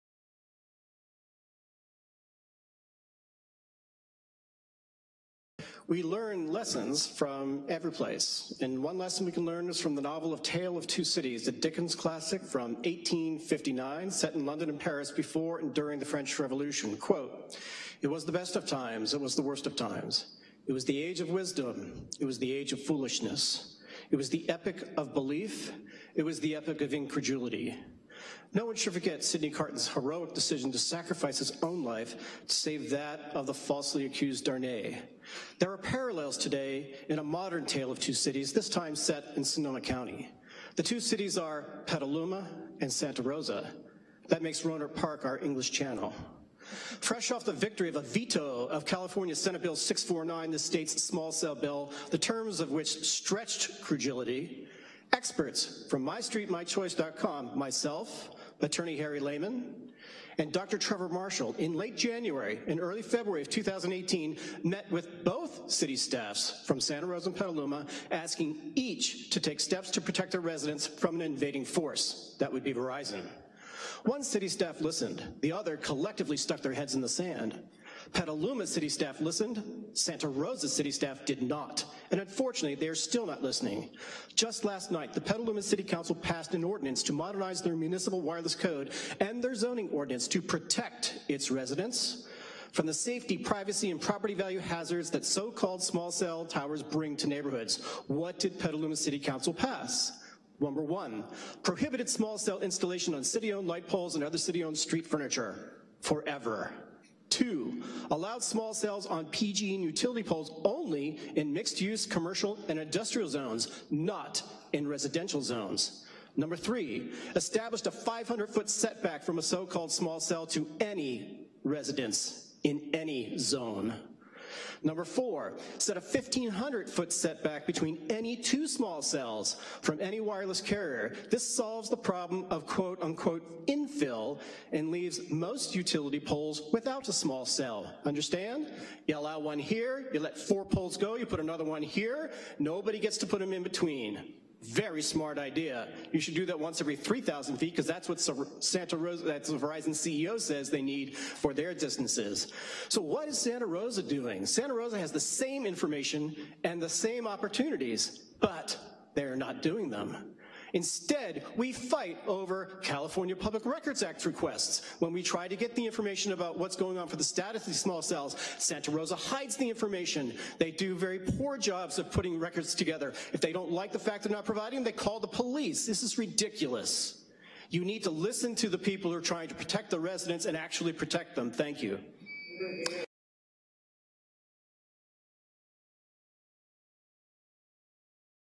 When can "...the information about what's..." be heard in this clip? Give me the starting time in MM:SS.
02:45.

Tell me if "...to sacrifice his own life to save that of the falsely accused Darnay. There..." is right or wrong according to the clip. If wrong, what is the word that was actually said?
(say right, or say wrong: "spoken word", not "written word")
right.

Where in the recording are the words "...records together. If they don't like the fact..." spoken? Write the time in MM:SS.
02:52.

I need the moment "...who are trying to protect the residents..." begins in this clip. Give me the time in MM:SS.
02:59.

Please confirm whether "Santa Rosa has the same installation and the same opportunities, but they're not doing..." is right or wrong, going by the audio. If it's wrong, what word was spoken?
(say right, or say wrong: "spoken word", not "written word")
wrong: "information", not "installation".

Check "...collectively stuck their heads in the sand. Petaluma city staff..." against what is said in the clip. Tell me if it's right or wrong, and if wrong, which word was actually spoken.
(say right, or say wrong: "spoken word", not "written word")
right.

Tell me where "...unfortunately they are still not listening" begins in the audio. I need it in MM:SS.
01:22.